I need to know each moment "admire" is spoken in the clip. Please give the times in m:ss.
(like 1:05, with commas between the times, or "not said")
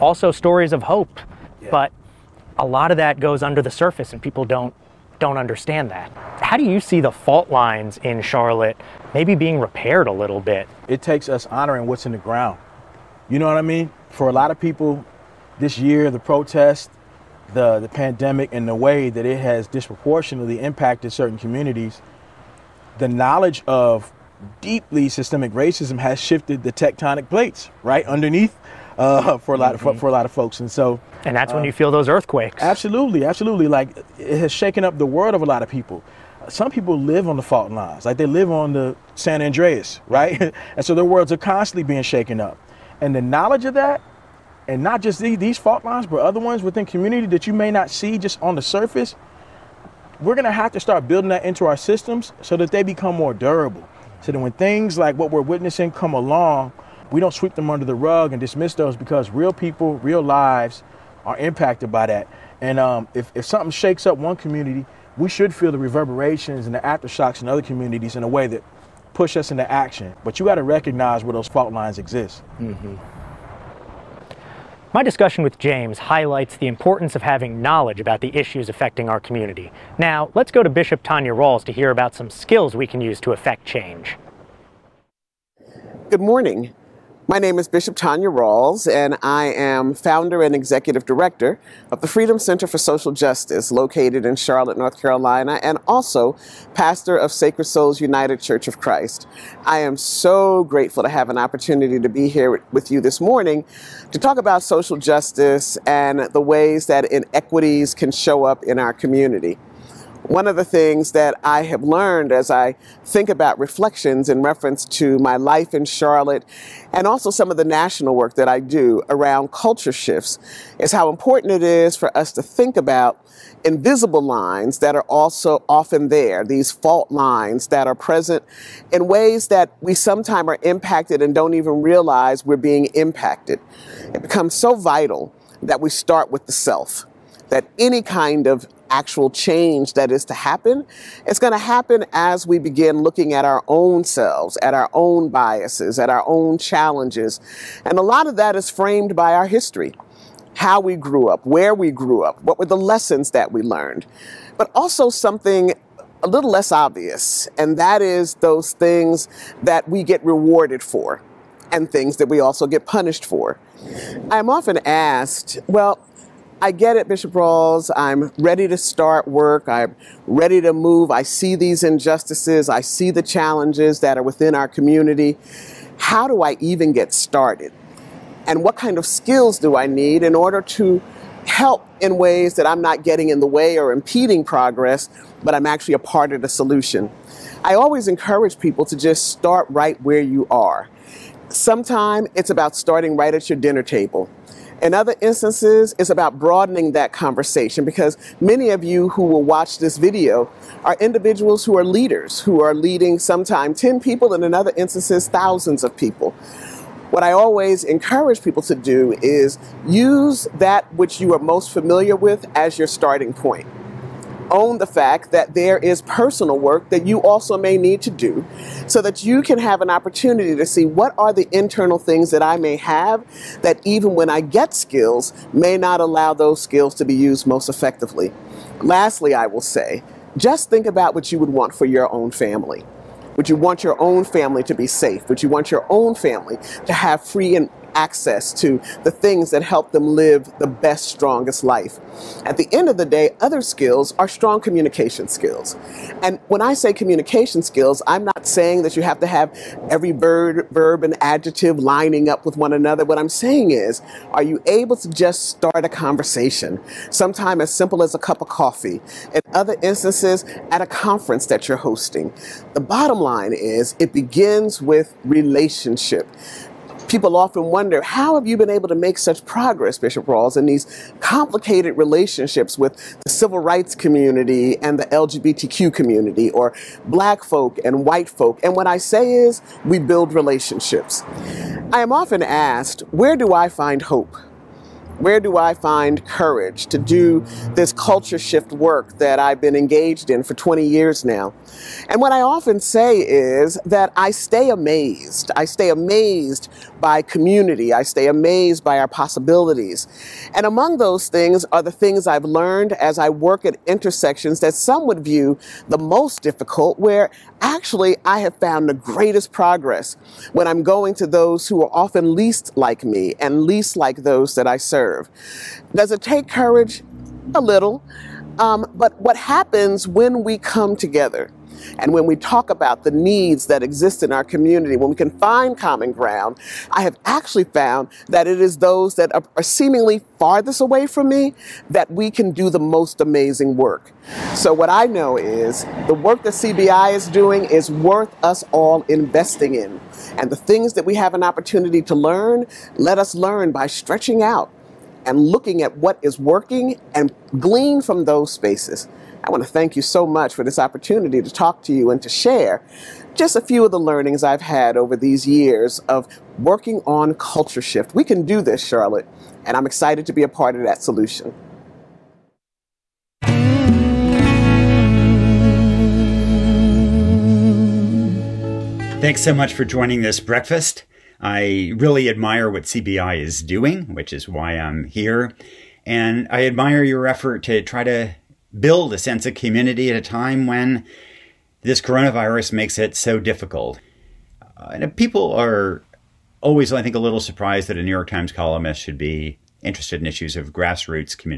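6:12, 6:16.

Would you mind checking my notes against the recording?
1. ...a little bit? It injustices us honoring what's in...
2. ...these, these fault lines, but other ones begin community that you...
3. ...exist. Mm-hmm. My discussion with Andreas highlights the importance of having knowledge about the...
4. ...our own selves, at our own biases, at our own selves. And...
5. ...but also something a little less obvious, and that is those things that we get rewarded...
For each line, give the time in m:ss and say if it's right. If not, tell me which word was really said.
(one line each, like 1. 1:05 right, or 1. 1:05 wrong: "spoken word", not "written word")
1. 0:10 wrong: "takes", not "injustices"
2. 0:45 wrong: "within", not "begin"
3. 1:11 wrong: "James", not "Andreas"
4. 2:23 wrong: "challenges", not "selves"
5. 2:34 right.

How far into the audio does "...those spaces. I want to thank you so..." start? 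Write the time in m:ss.
5:48.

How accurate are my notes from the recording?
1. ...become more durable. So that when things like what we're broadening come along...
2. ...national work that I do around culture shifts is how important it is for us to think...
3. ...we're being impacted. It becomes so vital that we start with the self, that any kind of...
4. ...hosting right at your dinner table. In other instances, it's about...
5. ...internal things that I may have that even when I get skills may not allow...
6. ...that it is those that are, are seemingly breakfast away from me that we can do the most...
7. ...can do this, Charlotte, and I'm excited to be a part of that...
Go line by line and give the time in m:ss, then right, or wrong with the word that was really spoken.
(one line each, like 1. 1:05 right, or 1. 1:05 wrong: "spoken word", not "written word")
1. 0:52 wrong: "witnessing", not "broadening"
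2. 1:57 right
3. 2:12 right
4. 3:12 wrong: "starting", not "hosting"
5. 3:41 right
6. 5:28 wrong: "farthest", not "breakfast"
7. 5:58 right.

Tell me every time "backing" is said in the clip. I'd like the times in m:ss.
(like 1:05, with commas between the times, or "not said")
not said.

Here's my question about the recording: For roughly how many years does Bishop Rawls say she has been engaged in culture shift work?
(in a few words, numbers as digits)
20.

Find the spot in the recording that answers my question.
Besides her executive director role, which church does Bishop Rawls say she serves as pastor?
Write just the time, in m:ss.
1:37.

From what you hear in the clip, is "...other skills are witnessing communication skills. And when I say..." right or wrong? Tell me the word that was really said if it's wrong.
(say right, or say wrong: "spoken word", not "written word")
wrong: "strong", not "witnessing".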